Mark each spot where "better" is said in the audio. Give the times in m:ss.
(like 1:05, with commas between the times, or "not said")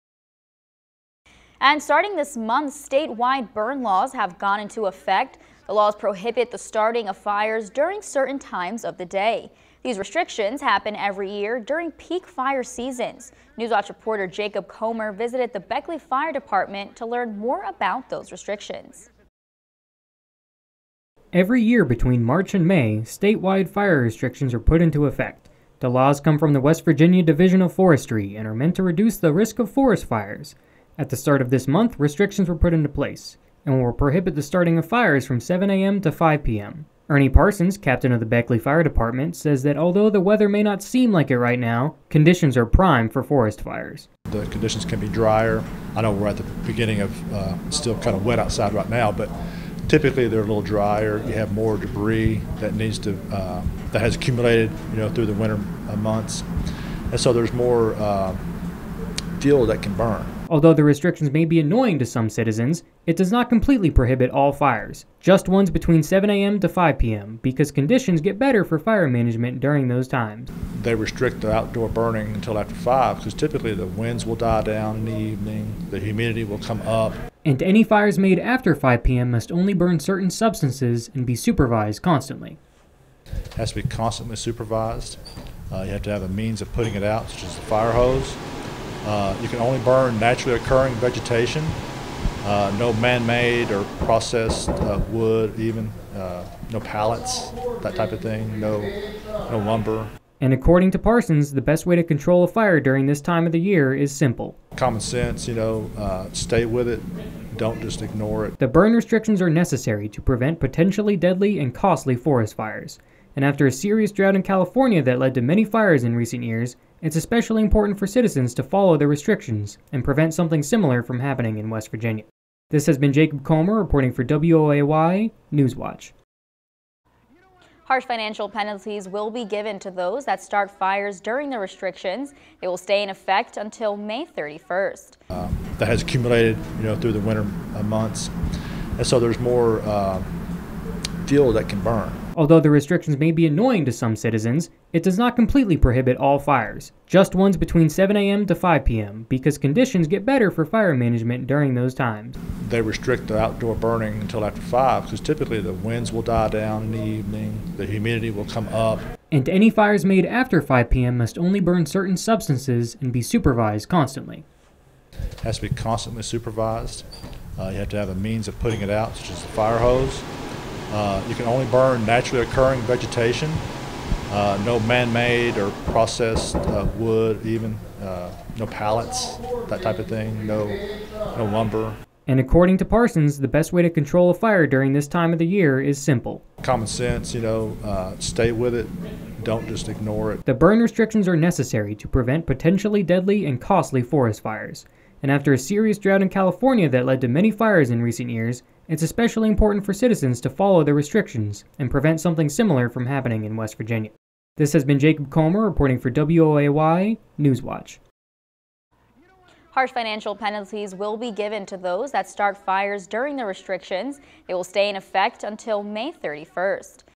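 1:08, 2:30.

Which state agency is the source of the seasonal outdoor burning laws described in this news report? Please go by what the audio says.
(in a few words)
West Virginia Division of Forestry.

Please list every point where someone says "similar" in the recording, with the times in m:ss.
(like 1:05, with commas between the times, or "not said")
2:00, 3:22.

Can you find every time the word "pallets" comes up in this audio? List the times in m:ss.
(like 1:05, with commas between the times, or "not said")
1:36, 2:58.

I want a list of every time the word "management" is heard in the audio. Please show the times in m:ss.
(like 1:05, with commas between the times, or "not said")
1:09, 2:30.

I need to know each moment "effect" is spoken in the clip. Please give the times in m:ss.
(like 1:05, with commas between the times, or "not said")
0:04, 0:25, 2:13, 3:34.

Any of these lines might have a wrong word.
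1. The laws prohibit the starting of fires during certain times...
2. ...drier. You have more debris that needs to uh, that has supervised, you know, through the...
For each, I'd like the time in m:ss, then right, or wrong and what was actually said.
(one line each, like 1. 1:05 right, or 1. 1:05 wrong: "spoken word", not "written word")
1. 0:05 right
2. 0:50 wrong: "accumulated", not "supervised".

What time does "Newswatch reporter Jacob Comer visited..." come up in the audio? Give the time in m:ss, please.
0:13.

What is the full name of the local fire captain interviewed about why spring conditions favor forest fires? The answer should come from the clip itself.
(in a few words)
Ernie Parsons.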